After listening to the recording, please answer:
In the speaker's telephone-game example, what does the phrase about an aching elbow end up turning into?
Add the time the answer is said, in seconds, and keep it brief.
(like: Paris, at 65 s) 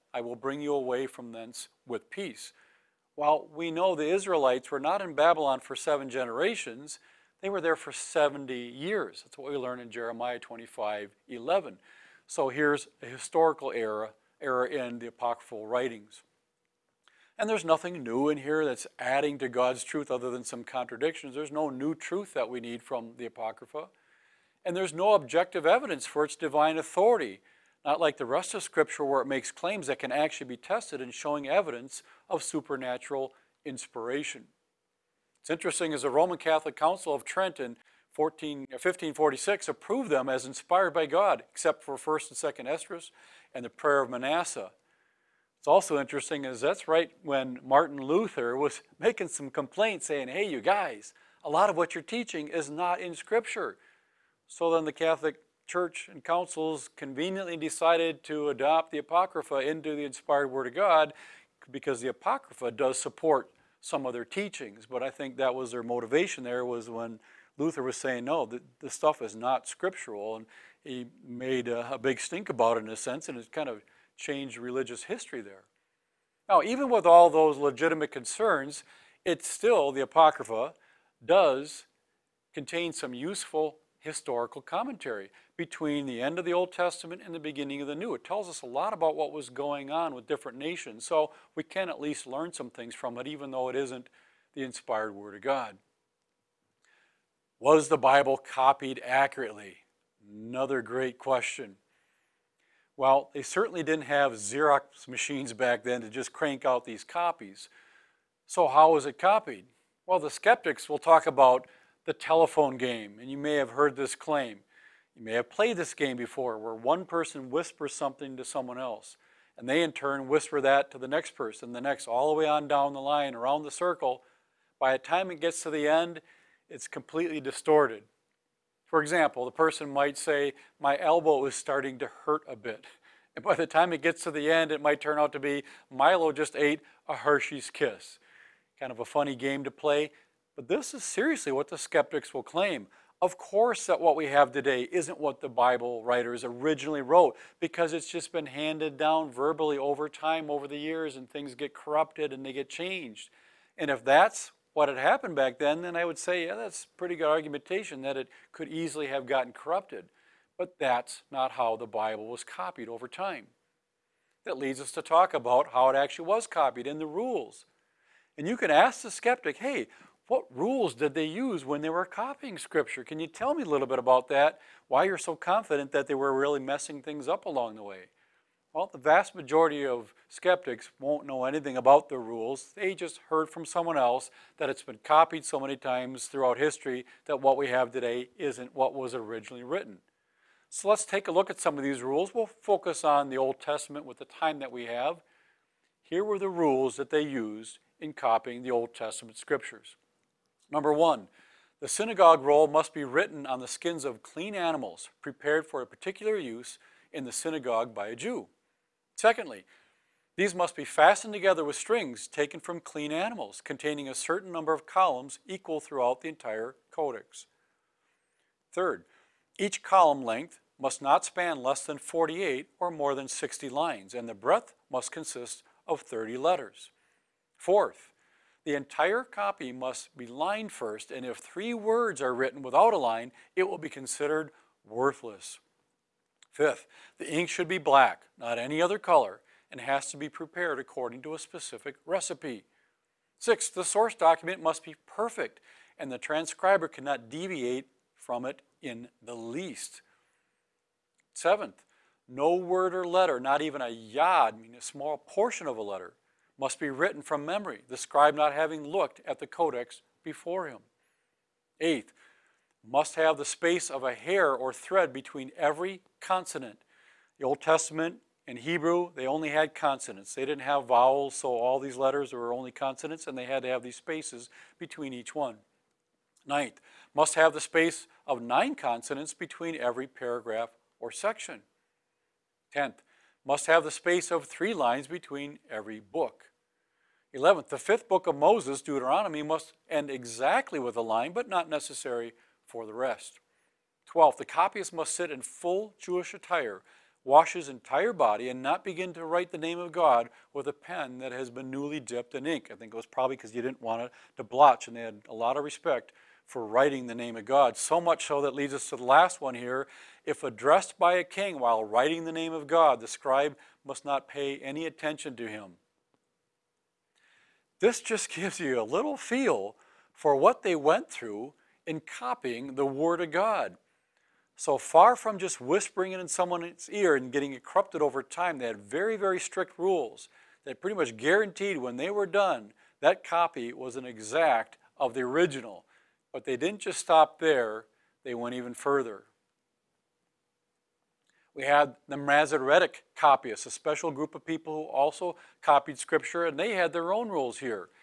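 Milo just ate a Hershey's kiss, at 135 s.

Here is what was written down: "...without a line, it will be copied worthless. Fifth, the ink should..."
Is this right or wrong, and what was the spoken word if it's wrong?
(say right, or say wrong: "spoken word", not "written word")
wrong: "considered", not "copied".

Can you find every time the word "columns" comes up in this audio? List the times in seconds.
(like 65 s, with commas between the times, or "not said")
214 s, 219 s.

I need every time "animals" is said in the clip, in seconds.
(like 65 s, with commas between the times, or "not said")
204 s, 213 s.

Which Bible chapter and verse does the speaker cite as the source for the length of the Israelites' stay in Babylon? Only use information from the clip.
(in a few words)
Jeremiah 25:11.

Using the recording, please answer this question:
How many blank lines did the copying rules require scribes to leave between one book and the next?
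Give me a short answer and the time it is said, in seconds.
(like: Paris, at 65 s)
3, at 284 s.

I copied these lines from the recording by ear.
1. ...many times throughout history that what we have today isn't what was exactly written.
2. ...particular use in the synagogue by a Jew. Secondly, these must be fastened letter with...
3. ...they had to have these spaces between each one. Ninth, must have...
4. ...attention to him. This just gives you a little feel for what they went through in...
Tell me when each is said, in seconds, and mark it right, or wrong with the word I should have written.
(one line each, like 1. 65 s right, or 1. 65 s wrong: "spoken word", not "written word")
1. 185 s wrong: "originally", not "exactly"
2. 205 s wrong: "together", not "letter"
3. 273 s right
4. 314 s right.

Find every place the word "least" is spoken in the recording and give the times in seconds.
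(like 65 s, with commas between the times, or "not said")
92 s, 249 s.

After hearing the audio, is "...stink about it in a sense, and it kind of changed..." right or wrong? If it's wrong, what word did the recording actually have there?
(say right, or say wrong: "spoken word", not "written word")
right.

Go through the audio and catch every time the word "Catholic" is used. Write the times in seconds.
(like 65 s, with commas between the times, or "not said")
36 s, 54 s.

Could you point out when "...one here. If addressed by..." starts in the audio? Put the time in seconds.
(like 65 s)
309 s.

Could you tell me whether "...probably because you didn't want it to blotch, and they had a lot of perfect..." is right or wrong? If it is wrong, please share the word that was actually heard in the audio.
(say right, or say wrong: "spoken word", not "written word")
wrong: "respect", not "perfect".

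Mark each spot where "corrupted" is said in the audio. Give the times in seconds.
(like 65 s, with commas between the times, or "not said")
151 s, 159 s, 327 s.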